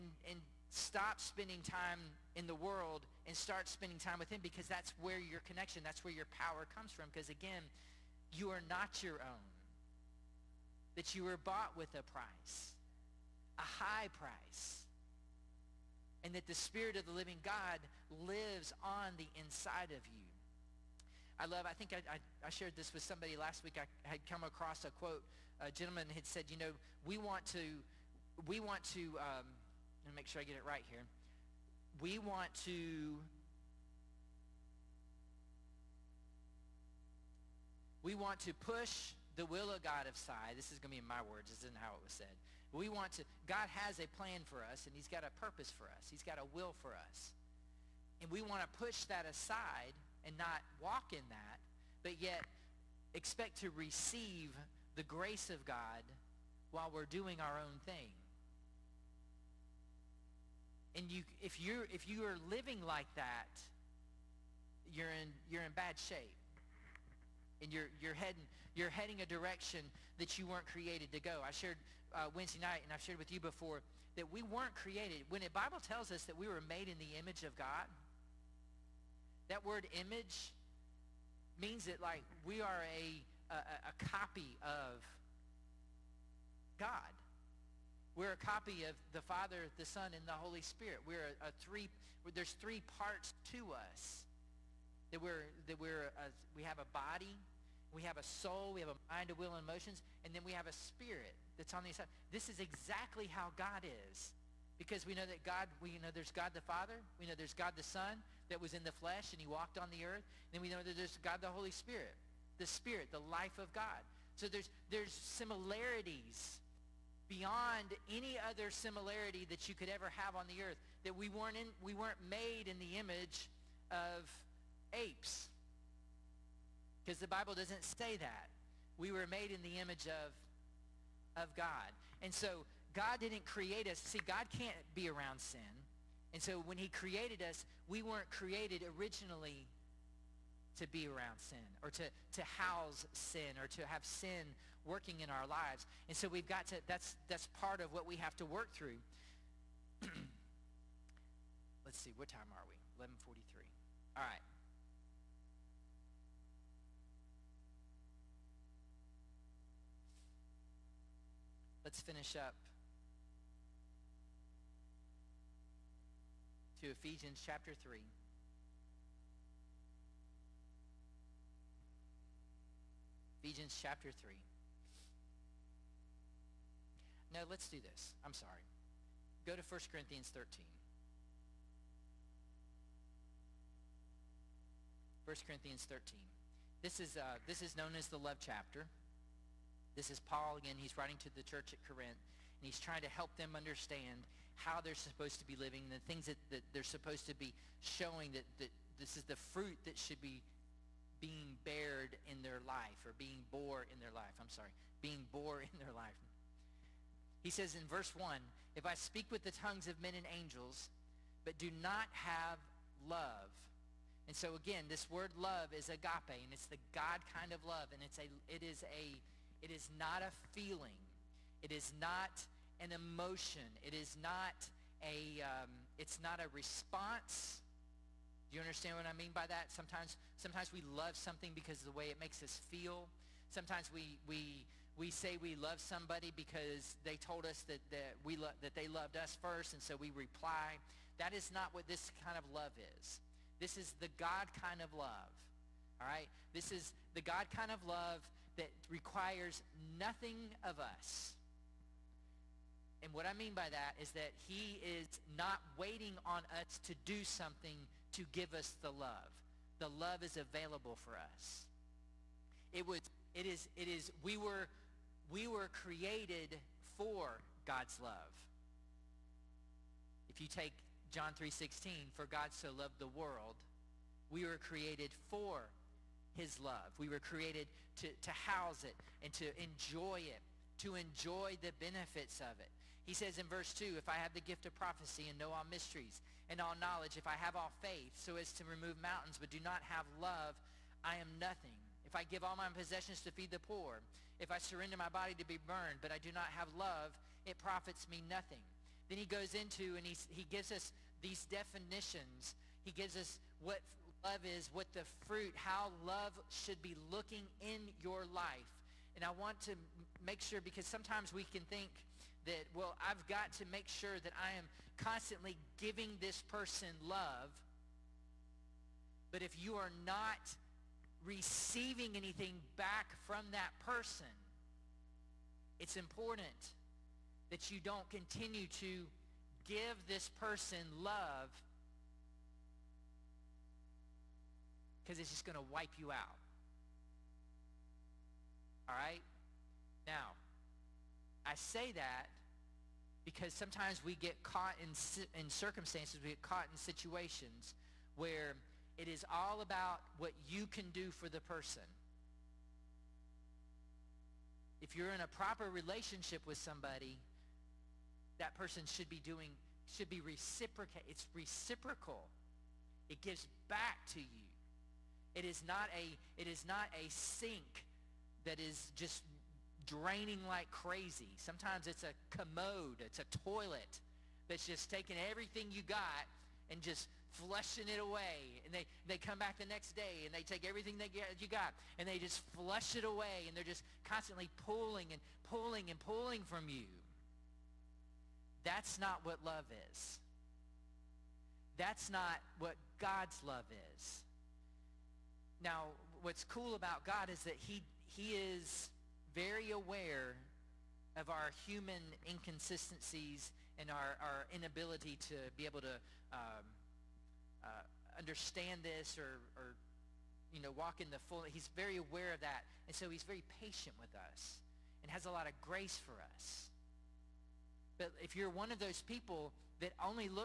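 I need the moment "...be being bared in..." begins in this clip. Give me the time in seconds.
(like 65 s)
200 s.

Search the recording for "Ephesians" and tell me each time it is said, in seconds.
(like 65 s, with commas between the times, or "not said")
166 s, 173 s.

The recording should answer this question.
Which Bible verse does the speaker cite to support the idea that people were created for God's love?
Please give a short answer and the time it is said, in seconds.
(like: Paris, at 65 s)
John 3:16, at 271 s.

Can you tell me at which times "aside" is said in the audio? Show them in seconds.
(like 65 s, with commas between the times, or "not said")
40 s, 49 s.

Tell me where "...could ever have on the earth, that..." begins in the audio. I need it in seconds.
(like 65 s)
119 s.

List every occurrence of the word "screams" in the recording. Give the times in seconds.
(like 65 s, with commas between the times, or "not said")
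not said.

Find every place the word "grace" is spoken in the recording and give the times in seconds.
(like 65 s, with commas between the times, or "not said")
55 s, 415 s.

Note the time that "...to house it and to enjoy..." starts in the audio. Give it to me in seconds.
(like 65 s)
278 s.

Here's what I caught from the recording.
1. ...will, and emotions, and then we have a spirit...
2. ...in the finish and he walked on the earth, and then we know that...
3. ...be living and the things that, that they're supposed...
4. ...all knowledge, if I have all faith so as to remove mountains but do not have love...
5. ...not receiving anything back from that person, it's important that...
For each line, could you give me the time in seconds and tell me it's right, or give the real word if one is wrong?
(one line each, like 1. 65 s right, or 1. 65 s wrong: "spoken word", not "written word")
1. 99 s right
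2. 108 s wrong: "flesh", not "finish"
3. 195 s right
4. 286 s right
5. 320 s right.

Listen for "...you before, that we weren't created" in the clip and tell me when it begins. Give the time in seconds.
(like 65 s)
73 s.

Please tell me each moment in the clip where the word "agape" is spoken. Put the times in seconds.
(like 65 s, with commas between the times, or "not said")
215 s.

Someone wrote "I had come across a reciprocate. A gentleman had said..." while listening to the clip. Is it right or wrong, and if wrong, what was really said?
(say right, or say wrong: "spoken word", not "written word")
wrong: "quote", not "reciprocate".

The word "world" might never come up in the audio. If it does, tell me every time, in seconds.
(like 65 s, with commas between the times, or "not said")
2 s, 273 s.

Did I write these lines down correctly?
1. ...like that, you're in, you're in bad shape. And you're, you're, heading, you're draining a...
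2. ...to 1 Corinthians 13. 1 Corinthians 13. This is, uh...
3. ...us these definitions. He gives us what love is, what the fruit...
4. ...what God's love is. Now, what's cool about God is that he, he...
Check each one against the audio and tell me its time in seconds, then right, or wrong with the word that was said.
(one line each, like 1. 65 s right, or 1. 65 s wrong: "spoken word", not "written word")
1. 62 s wrong: "heading", not "draining"
2. 179 s right
3. 300 s right
4. 392 s right.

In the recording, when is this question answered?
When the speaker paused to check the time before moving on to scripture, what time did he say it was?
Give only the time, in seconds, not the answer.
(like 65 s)
152 s.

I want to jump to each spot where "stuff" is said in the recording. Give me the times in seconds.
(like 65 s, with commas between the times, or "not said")
not said.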